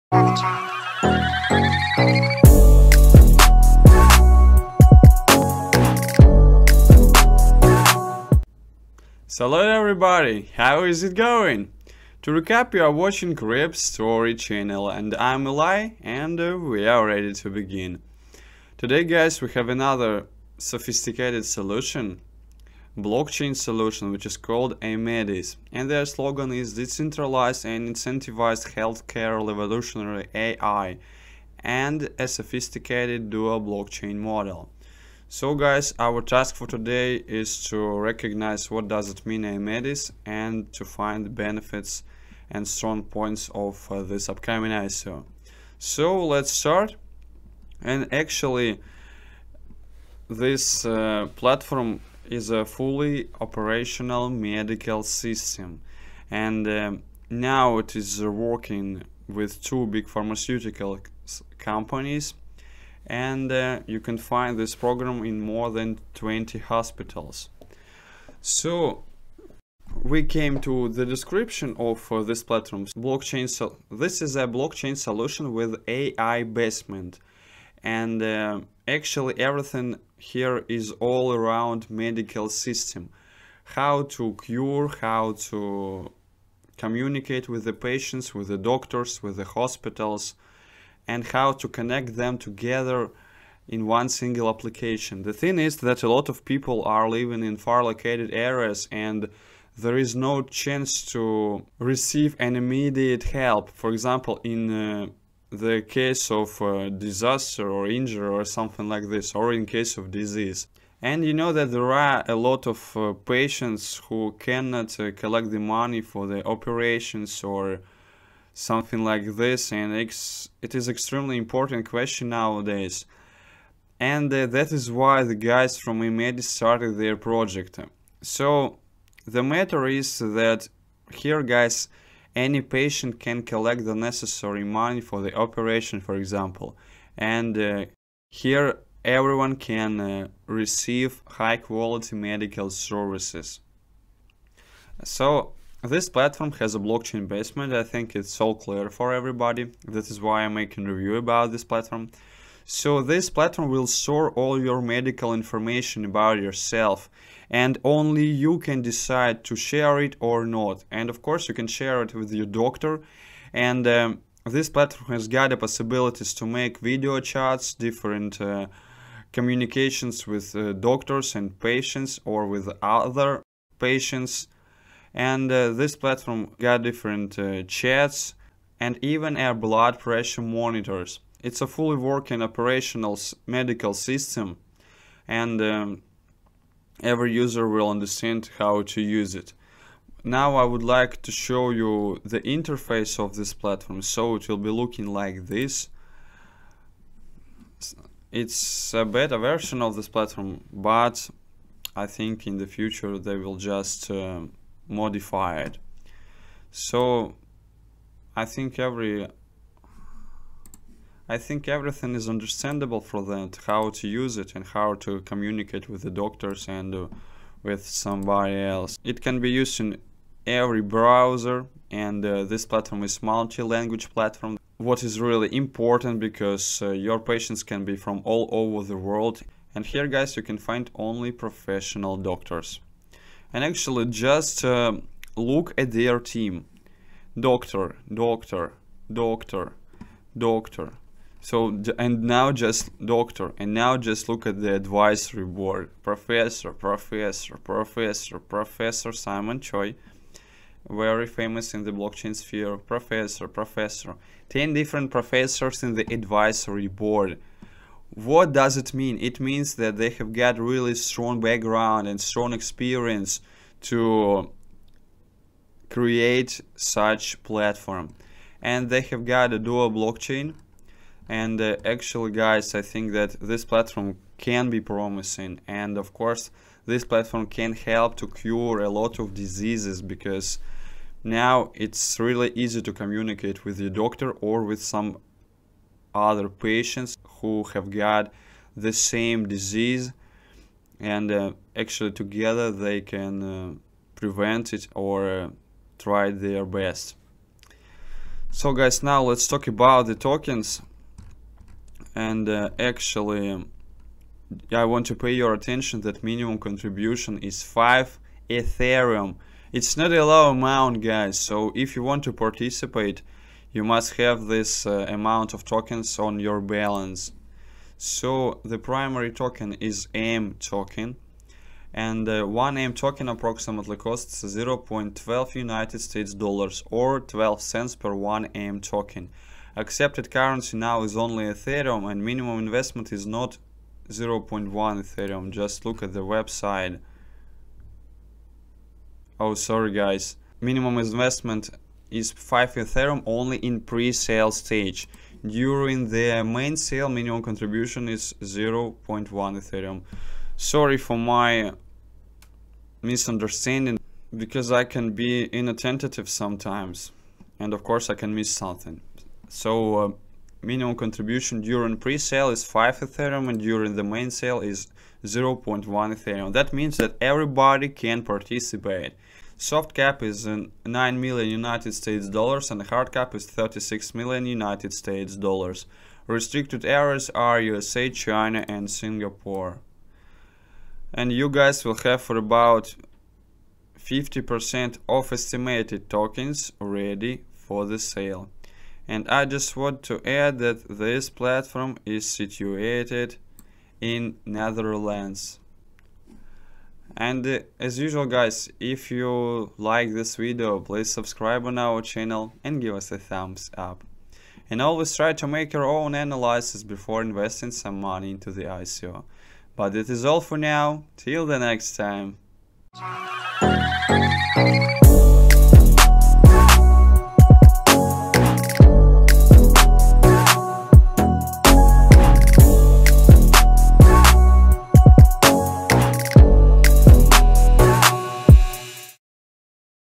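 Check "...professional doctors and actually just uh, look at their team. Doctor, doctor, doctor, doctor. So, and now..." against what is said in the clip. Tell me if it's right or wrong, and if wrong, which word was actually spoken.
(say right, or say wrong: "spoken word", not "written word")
right.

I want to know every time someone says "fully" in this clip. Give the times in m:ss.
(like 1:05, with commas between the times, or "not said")
0:52, 3:01.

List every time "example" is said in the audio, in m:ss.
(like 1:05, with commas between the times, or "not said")
1:43, 2:16.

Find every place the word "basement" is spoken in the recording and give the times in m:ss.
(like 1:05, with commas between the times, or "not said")
1:16, 2:27.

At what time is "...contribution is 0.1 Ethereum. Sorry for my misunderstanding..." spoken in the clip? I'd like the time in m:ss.
5:47.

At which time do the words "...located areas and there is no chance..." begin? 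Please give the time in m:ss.
1:37.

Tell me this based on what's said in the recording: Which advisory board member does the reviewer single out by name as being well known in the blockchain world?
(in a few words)
Simon Choi.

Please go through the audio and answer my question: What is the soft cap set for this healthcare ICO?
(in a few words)
$9 million.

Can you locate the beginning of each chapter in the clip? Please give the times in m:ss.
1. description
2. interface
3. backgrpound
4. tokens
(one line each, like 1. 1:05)
1. 0:47
2. 3:12
3. 3:53
4. 5:00.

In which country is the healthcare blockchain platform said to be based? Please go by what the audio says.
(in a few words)
Netherlands.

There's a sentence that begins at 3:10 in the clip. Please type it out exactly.
Now I would like to show you the interface of this platform.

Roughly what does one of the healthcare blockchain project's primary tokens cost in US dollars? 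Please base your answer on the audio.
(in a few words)
$0.12.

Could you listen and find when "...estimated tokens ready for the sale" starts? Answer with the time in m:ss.
6:25.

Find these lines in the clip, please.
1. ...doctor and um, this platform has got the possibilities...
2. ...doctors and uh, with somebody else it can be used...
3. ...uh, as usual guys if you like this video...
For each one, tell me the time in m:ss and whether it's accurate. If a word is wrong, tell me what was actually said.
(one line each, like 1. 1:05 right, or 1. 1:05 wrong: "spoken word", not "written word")
1. 2:42 right
2. 3:36 right
3. 6:37 right.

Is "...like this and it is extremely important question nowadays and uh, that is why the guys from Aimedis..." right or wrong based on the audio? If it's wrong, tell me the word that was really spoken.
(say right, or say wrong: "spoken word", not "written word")
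right.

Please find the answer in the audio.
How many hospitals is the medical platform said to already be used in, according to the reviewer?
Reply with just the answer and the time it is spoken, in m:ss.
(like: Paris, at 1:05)
more than 20, at 1:05.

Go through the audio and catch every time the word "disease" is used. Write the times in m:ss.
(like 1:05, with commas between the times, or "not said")
1:50, 4:39, 4:49.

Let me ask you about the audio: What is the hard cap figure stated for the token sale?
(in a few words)
$36 million.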